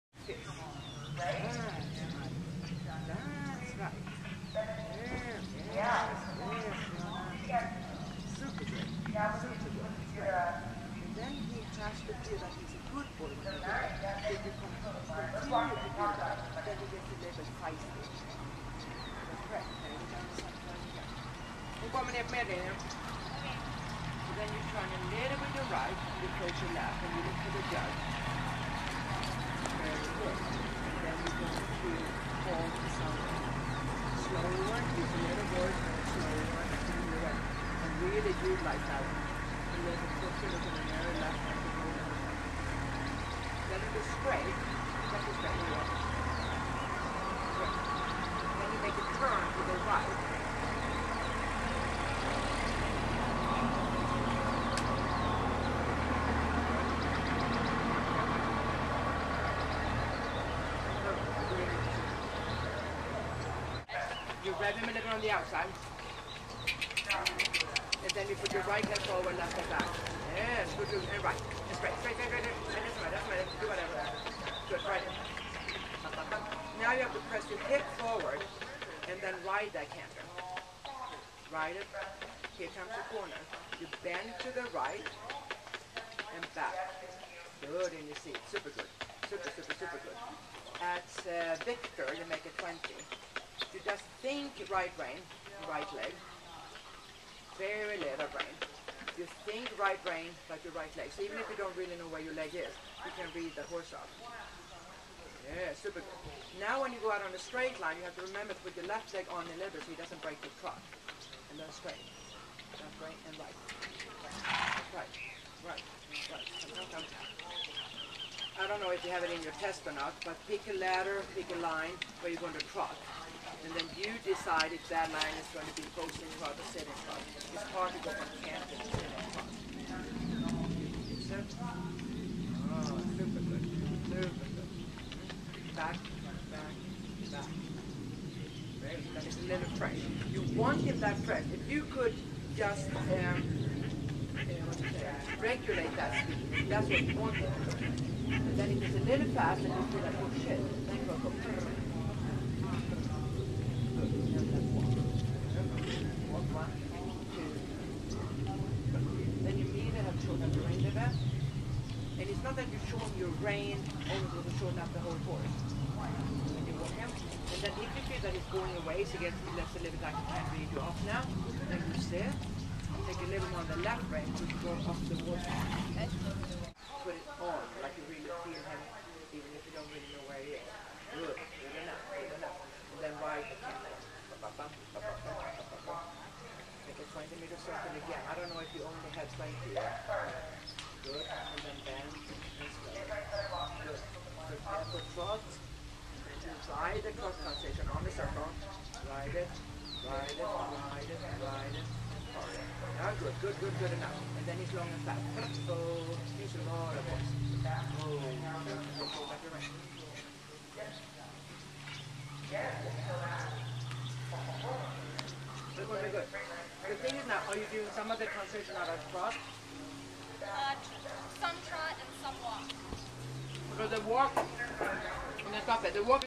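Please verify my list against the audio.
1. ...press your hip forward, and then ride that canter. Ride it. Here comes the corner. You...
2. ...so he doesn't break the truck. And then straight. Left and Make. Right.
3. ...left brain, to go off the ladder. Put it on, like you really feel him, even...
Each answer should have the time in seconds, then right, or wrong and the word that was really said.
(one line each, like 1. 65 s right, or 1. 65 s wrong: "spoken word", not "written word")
1. 77 s right
2. 109 s wrong: "Right", not "Make"
3. 173 s wrong: "water", not "ladder".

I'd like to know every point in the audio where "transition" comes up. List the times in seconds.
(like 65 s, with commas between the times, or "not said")
197 s, 218 s.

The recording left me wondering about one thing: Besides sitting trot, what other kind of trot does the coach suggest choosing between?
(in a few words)
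Posting trot.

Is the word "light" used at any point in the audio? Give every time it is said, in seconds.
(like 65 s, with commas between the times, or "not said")
38 s.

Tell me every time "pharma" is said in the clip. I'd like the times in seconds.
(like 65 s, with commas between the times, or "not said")
not said.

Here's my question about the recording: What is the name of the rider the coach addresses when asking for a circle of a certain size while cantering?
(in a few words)
Victor.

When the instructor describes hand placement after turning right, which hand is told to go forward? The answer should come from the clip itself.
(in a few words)
Right hand.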